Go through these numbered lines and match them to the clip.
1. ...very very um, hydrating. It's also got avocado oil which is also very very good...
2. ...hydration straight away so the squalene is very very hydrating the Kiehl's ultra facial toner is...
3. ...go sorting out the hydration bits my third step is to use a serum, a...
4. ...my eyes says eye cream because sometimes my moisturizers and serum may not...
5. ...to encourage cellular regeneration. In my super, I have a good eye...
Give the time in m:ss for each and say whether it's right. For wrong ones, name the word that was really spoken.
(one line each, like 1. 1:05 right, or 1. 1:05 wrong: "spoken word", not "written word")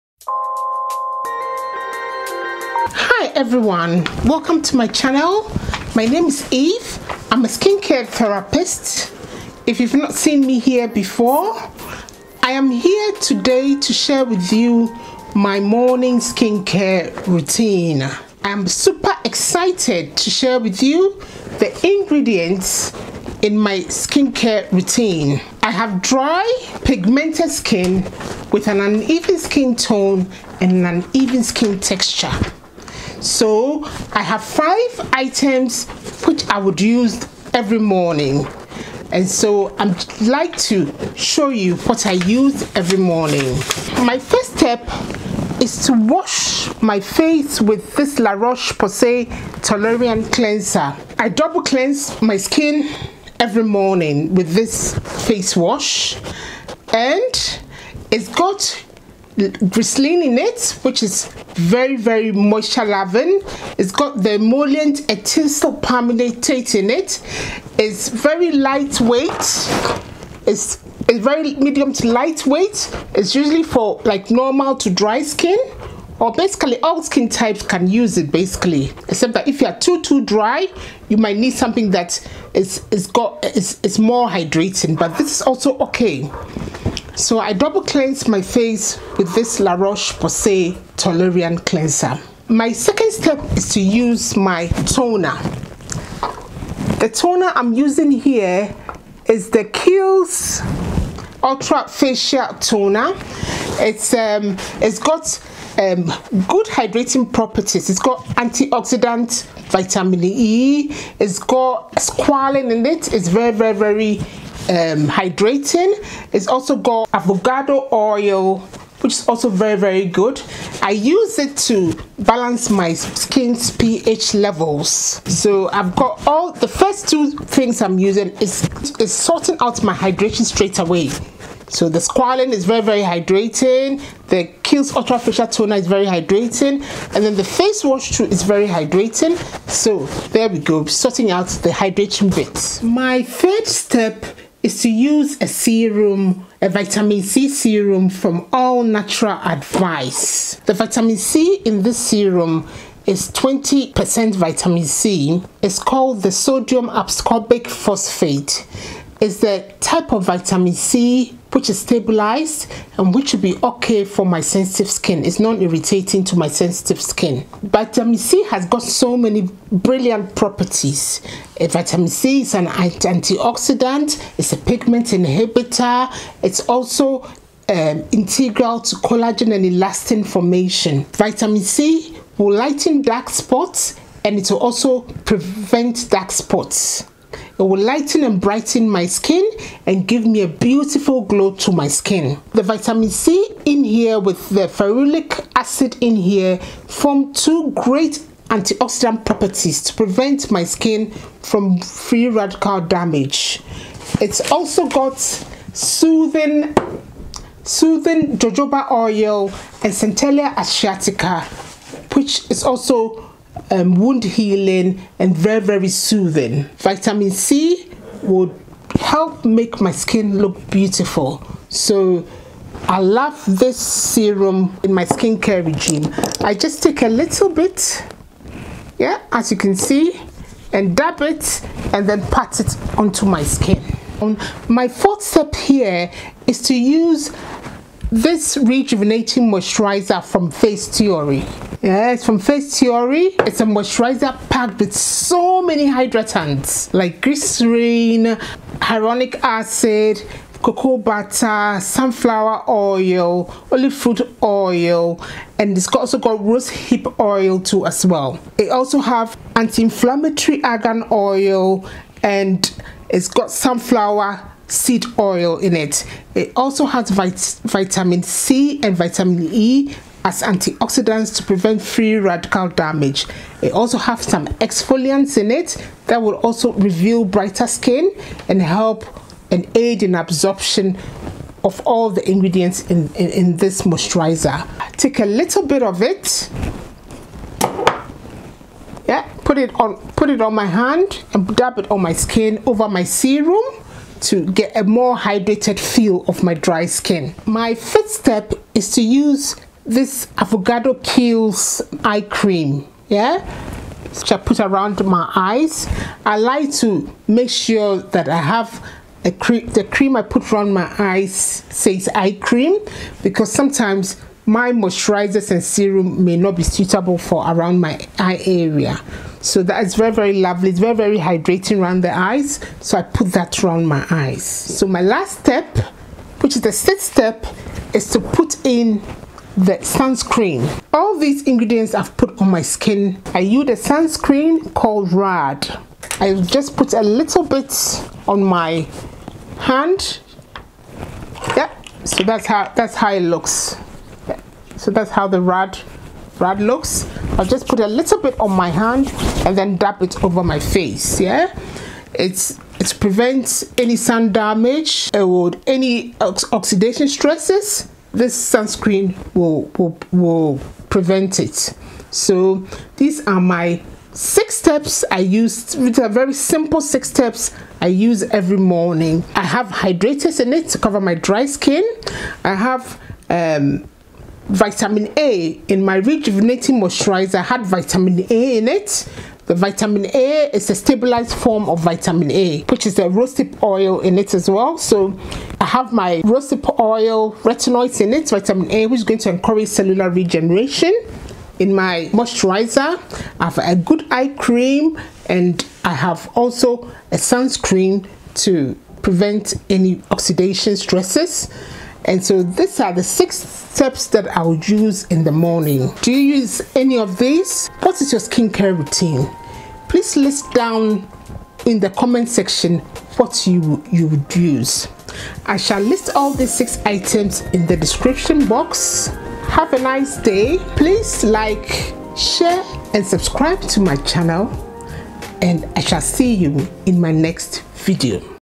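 1. 1:53 right
2. 2:09 right
3. 2:20 right
4. 5:10 right
5. 6:29 wrong: "moisturizer", not "super".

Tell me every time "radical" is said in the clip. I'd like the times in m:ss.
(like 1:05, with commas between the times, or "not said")
3:22, 4:32.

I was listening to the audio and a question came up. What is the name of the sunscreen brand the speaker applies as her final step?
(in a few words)
Radd.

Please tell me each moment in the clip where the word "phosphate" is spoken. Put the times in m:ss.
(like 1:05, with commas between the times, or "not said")
2:37.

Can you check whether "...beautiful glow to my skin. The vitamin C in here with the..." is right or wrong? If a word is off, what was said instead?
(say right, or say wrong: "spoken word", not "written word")
right.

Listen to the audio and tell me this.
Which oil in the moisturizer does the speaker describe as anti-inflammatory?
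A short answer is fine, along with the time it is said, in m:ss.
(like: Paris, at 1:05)
argan oil, at 4:20.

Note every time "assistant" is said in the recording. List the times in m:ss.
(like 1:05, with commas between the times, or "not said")
not said.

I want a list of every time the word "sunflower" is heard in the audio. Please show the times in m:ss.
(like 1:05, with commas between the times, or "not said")
4:11, 4:23.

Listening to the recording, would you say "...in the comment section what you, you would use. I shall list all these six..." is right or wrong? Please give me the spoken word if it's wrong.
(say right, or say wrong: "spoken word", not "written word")
right.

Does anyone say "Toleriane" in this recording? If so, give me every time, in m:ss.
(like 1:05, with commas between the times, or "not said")
0:49, 1:30.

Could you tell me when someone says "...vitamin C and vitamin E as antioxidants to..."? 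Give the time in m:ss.
4:27.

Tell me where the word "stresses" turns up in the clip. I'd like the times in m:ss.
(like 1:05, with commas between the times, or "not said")
5:57, 6:40.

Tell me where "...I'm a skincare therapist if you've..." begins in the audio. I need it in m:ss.
0:07.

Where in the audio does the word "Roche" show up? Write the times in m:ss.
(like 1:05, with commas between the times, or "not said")
0:48, 1:29.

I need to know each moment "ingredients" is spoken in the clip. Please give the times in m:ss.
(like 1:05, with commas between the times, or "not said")
0:21, 4:42, 5:31.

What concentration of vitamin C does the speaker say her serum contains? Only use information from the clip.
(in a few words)
20%.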